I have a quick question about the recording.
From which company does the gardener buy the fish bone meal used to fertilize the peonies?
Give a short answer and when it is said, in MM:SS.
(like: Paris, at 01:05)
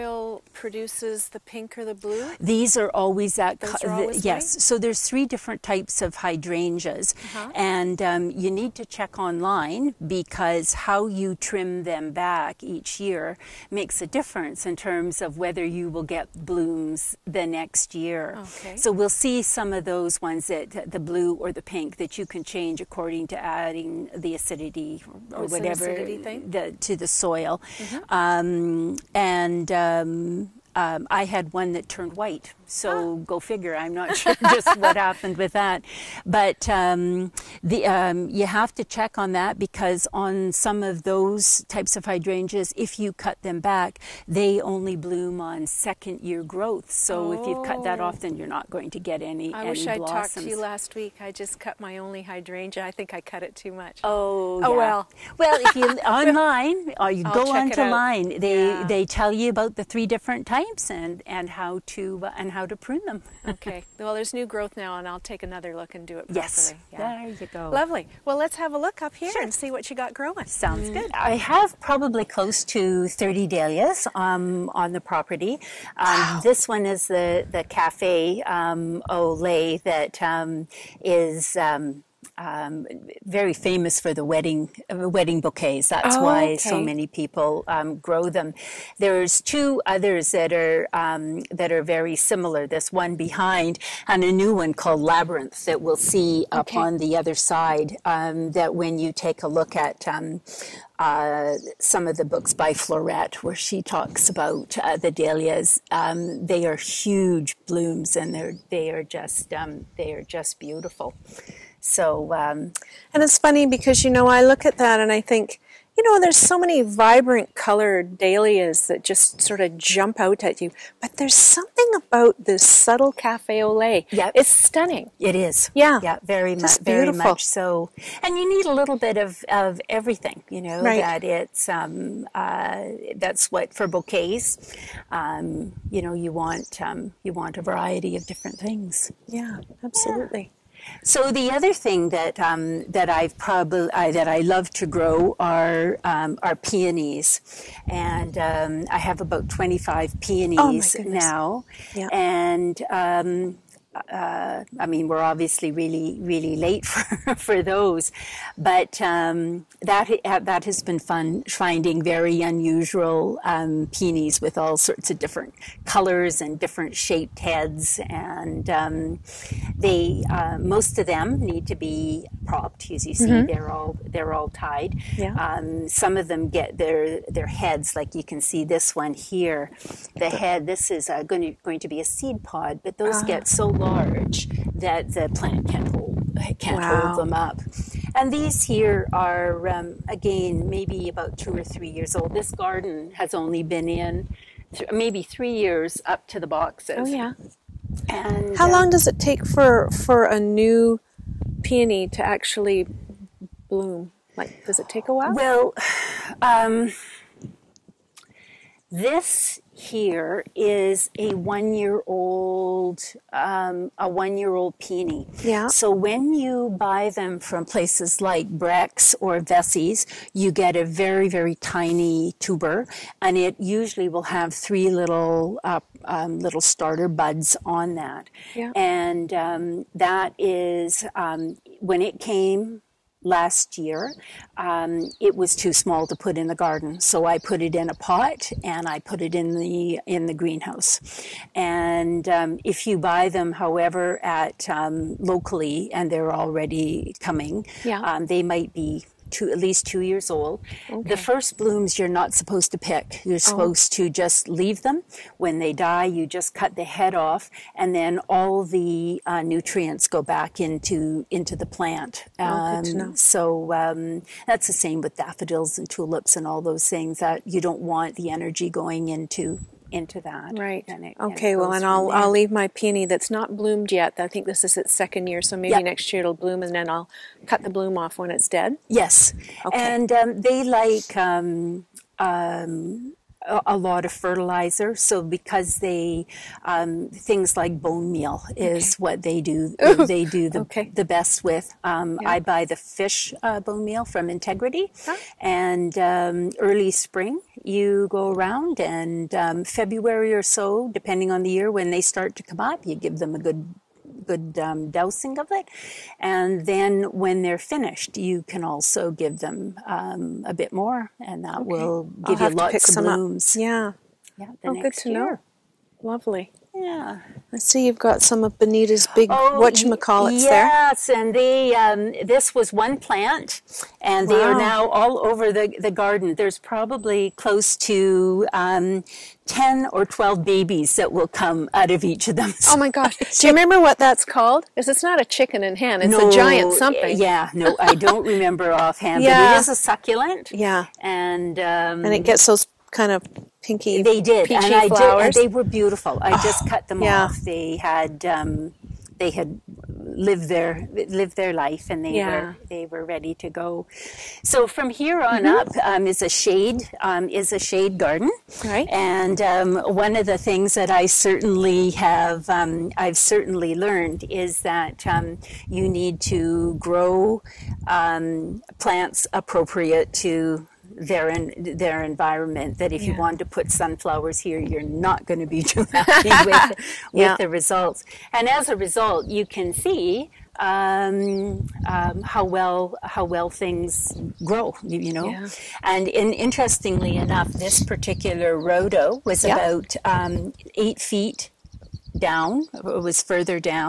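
Integrity, at 04:54.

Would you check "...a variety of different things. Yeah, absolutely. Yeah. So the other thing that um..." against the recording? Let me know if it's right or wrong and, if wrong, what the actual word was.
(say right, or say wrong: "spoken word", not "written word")
right.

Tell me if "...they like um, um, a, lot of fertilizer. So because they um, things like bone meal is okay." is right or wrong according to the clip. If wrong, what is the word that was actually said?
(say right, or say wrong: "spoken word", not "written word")
right.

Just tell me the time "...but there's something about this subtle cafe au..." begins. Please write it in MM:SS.
02:01.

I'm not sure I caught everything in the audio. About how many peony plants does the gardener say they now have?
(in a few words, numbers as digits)
25.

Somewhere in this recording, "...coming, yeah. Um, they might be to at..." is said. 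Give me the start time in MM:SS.
04:07.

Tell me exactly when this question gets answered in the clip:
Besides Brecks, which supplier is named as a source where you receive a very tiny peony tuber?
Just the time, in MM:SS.
03:39.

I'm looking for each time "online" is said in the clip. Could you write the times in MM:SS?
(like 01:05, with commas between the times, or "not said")
00:09, 00:56.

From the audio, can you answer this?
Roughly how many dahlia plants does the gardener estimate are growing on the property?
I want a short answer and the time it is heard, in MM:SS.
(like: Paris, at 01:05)
30, at 01:12.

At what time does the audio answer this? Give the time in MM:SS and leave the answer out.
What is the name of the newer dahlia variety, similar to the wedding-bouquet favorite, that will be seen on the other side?
01:35.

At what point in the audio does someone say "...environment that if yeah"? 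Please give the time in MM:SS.
06:12.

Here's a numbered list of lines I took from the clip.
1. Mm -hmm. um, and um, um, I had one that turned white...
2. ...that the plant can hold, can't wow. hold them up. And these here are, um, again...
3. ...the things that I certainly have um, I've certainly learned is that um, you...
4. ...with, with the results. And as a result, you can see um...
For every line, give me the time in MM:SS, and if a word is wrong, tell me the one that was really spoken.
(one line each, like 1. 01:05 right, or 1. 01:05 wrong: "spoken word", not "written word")
1. 00:27 right
2. 03:04 right
3. 06:00 right
4. 06:16 right.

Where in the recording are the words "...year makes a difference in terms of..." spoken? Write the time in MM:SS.
00:13.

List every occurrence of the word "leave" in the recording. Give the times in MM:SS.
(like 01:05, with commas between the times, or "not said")
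04:14, 04:32.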